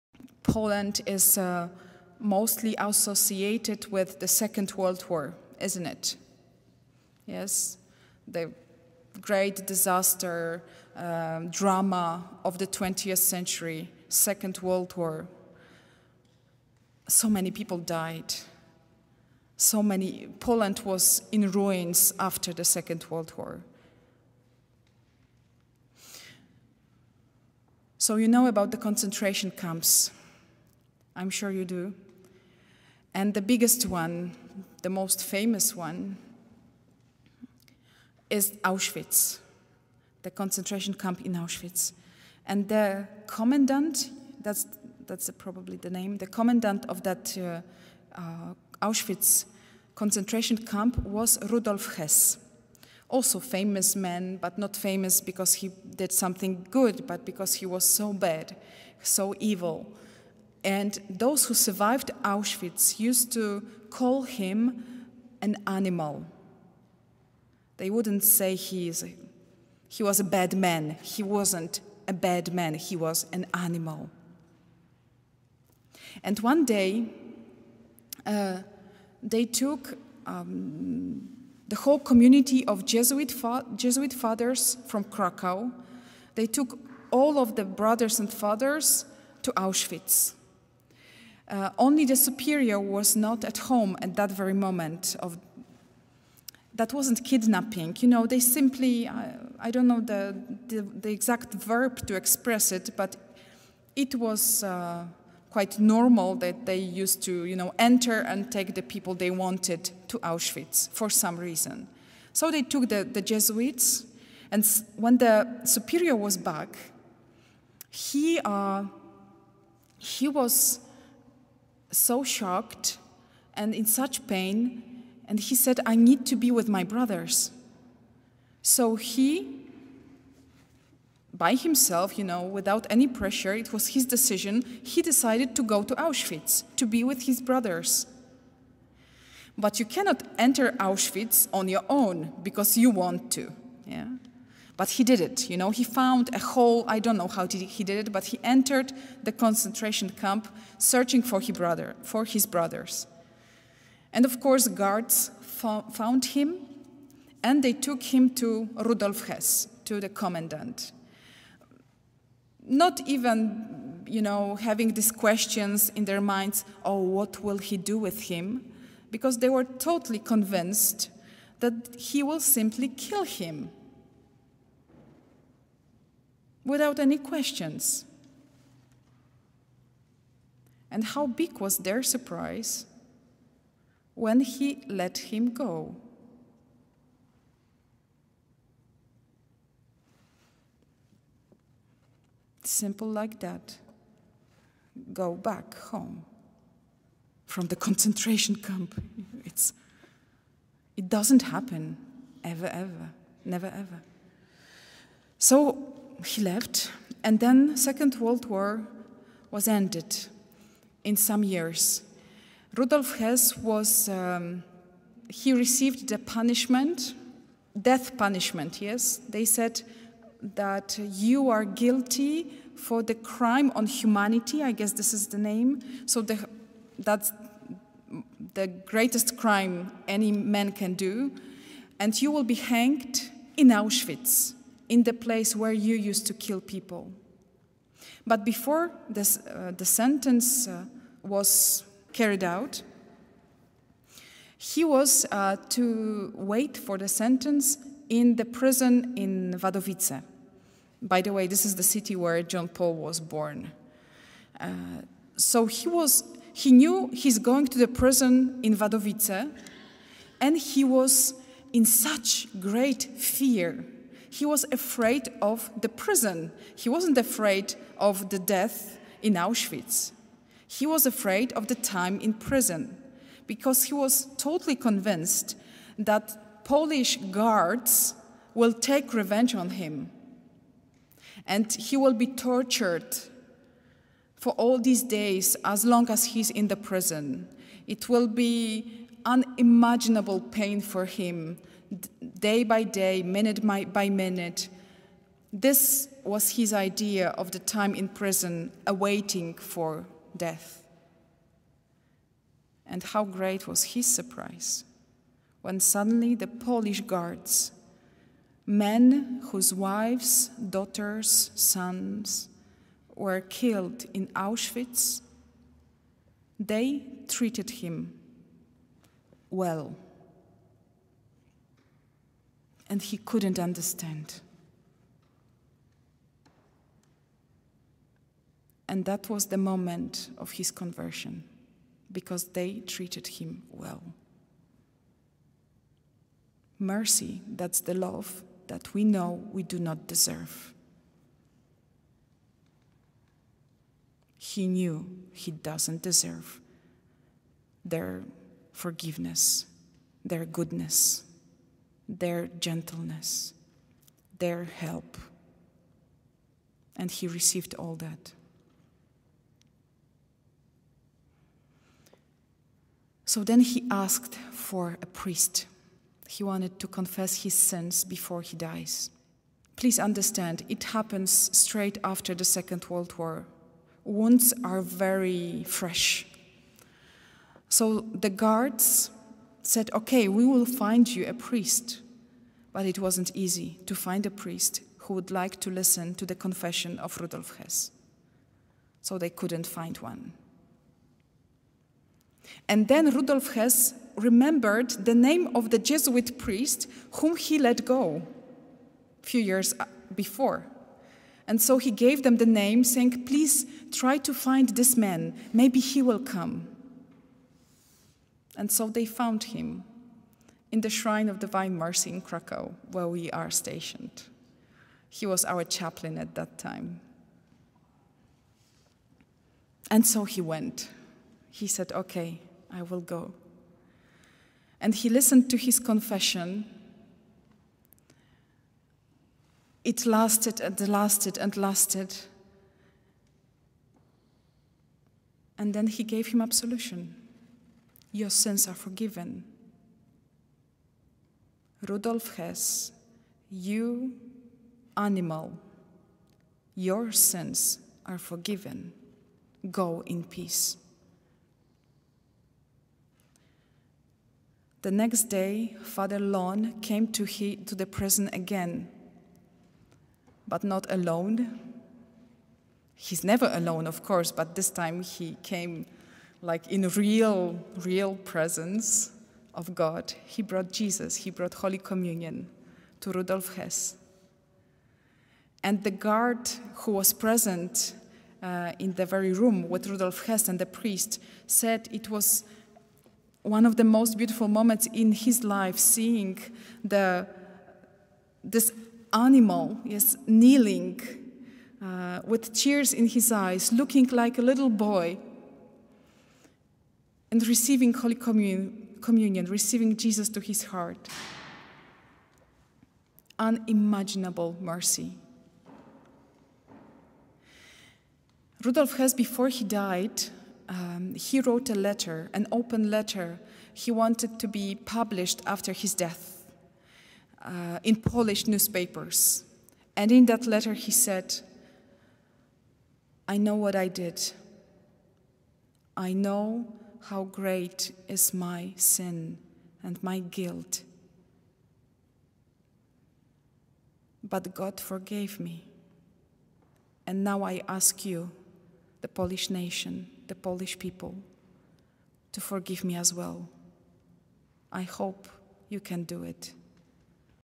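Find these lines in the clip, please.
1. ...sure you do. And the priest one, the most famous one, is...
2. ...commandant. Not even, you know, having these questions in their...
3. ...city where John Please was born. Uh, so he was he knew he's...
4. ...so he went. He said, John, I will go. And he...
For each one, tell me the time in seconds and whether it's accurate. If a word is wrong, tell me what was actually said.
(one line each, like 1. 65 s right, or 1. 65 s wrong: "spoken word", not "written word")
1. 31 s wrong: "biggest", not "priest"
2. 160 s right
3. 251 s wrong: "Paul", not "Please"
4. 420 s wrong: "Okay", not "John".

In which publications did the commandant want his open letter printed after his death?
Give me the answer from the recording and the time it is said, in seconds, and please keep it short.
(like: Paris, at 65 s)
Polish newspapers, at 517 s.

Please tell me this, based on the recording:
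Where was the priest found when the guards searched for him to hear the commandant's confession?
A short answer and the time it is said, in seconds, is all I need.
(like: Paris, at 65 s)
Shrine of Divine Mercy, at 410 s.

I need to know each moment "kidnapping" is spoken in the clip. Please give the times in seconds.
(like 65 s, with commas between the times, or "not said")
97 s.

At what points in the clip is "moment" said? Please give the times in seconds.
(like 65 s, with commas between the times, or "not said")
94 s, 329 s, 484 s.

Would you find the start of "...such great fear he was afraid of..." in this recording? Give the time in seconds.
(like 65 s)
261 s.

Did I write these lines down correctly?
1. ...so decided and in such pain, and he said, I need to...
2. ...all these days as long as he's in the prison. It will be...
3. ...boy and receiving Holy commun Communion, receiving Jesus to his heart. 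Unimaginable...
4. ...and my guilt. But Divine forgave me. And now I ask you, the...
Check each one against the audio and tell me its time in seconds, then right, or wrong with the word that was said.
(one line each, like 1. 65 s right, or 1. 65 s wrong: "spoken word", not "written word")
1. 121 s wrong: "shocked", not "decided"
2. 284 s right
3. 494 s right
4. 529 s wrong: "God", not "Divine".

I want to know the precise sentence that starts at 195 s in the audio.
Go back home from the concentration camp.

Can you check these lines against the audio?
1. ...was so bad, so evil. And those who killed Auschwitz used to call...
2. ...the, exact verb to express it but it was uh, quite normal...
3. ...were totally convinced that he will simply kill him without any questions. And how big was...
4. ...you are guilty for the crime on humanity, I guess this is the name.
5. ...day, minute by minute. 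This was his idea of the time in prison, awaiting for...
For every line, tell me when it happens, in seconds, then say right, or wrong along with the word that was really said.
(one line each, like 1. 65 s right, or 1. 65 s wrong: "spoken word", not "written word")
1. 57 s wrong: "survived", not "killed"
2. 100 s right
3. 169 s right
4. 221 s right
5. 292 s right.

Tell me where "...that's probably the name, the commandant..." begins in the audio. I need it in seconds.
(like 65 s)
45 s.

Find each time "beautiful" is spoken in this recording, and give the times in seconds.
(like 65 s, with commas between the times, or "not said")
484 s.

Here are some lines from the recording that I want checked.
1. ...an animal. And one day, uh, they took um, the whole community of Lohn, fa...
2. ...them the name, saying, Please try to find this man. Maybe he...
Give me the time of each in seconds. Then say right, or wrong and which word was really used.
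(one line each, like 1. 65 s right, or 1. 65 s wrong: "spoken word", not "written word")
1. 73 s wrong: "Jesuit", not "Lohn"
2. 402 s right.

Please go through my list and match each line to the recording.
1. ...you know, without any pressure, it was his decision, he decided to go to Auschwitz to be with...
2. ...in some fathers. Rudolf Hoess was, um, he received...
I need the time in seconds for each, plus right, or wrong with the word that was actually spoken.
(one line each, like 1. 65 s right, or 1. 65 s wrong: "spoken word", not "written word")
1. 132 s right
2. 211 s wrong: "years", not "fathers".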